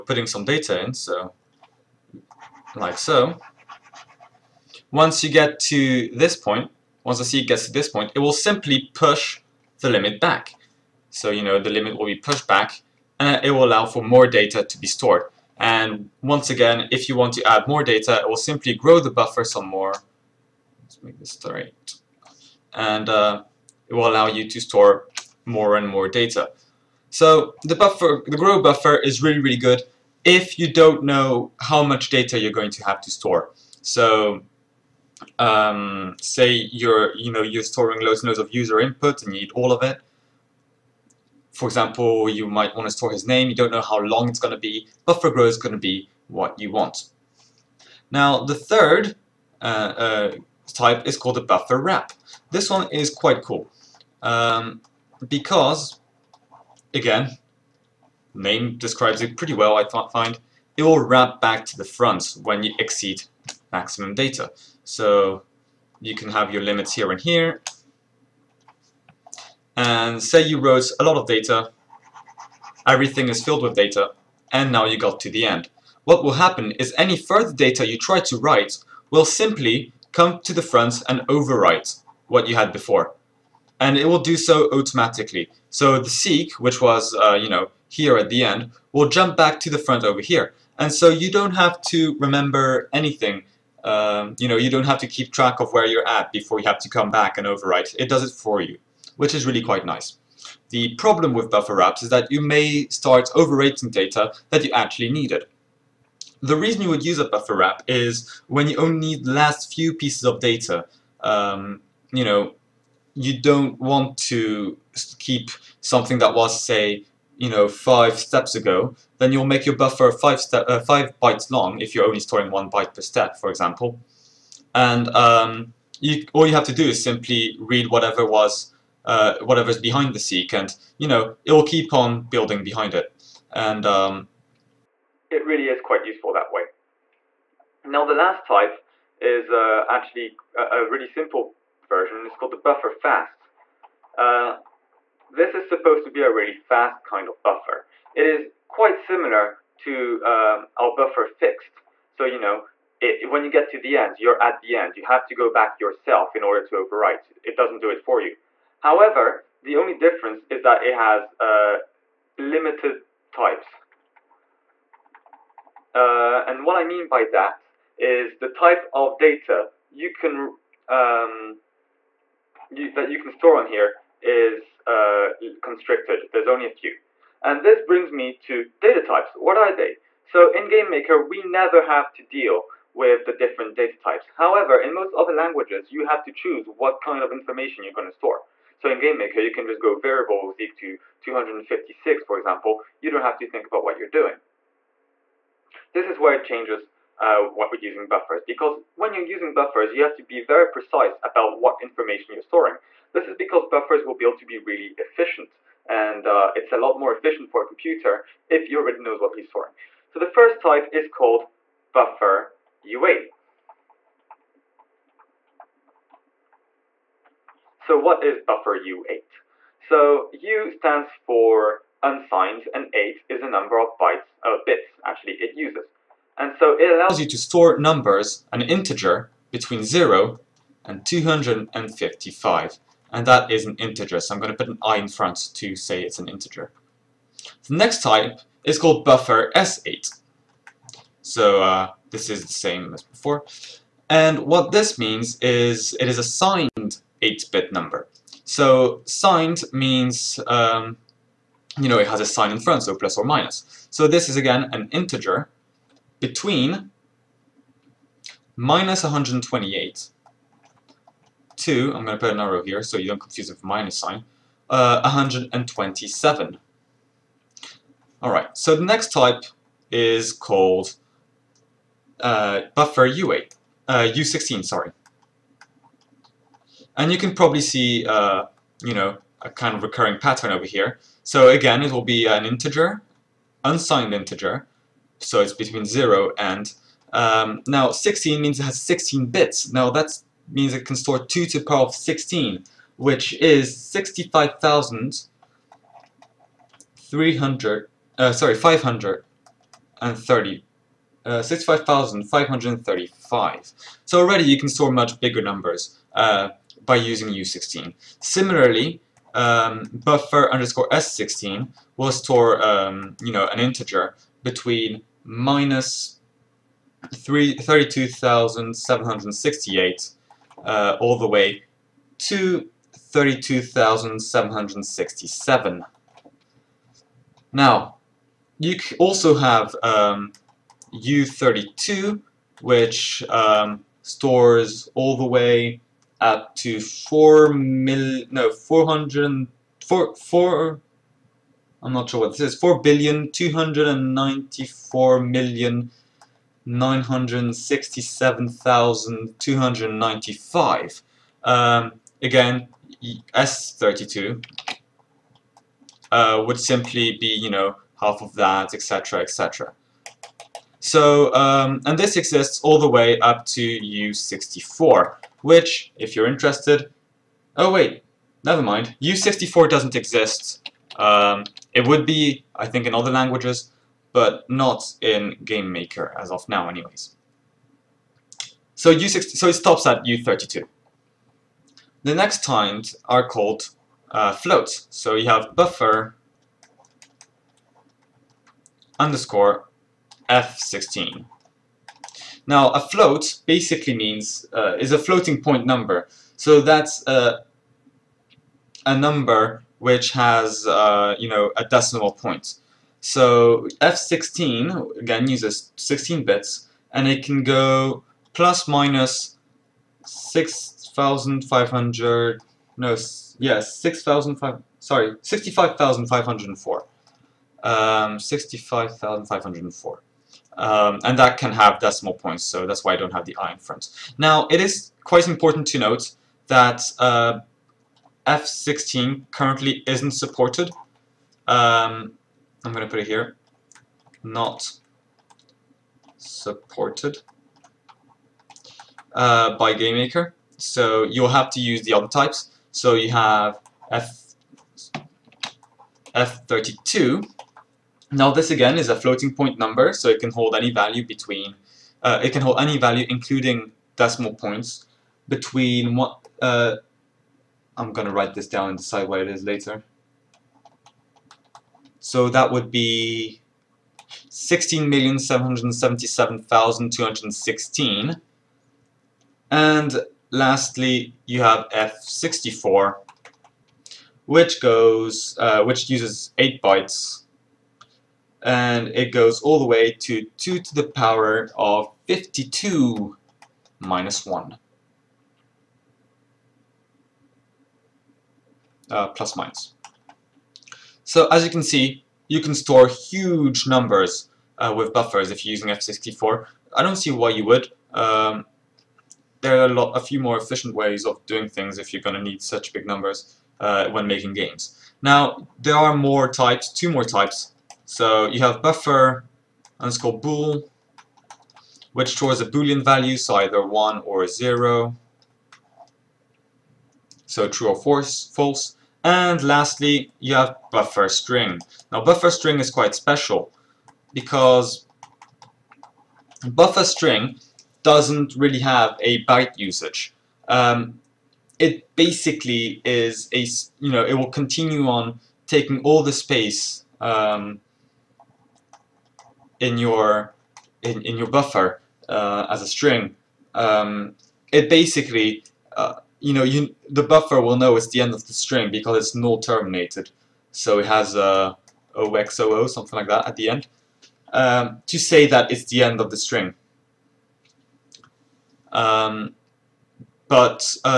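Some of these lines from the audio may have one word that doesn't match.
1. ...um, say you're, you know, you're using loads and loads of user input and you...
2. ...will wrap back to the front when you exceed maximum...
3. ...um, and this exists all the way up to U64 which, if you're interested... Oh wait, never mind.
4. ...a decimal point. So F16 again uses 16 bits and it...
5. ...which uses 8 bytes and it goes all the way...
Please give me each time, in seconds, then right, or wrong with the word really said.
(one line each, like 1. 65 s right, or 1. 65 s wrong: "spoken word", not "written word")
1. 35 s wrong: "storing", not "using"
2. 60 s right
3. 361 s right
4. 401 s right
5. 475 s right.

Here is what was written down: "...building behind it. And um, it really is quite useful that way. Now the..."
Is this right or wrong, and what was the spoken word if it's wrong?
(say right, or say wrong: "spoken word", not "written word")
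right.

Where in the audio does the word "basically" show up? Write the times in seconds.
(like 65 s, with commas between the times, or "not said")
393 s, 531 s, 544 s.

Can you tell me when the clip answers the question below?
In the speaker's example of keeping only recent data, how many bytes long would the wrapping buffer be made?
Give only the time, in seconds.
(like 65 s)
120 s.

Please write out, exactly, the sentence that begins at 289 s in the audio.
Now, that means it can store 2 to the power of 16, which is 65,300...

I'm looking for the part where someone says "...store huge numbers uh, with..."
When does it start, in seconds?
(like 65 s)
492 s.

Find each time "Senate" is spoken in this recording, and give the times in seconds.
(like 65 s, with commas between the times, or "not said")
not said.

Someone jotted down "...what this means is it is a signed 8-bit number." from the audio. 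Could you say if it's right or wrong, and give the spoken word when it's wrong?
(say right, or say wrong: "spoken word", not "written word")
right.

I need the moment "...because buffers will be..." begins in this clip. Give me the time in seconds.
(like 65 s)
203 s.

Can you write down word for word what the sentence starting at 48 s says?
Now, the third uh, uh, type is called a buffer wrap.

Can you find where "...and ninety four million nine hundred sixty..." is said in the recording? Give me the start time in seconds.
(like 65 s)
343 s.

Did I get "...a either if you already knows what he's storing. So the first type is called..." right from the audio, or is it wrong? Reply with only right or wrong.
wrong.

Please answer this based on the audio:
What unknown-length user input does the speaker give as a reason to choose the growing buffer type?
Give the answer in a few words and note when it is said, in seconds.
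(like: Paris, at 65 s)
his name, at 43 s.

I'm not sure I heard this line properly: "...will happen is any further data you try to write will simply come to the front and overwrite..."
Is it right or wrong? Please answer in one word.
right.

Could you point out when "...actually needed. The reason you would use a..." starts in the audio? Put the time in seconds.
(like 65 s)
104 s.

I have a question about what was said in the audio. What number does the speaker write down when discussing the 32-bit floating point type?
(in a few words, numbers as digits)
16,777,216.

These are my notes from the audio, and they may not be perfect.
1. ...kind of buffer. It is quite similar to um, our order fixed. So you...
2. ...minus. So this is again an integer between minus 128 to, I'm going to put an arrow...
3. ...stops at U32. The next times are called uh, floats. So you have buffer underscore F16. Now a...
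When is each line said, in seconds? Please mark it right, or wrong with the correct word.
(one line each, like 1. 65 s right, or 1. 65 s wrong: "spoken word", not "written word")
1. 147 s wrong: "buffer", not "order"
2. 253 s right
3. 379 s right.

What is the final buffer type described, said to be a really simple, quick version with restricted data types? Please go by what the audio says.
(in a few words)
buffer fast.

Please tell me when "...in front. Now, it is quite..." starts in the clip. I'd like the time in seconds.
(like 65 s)
423 s.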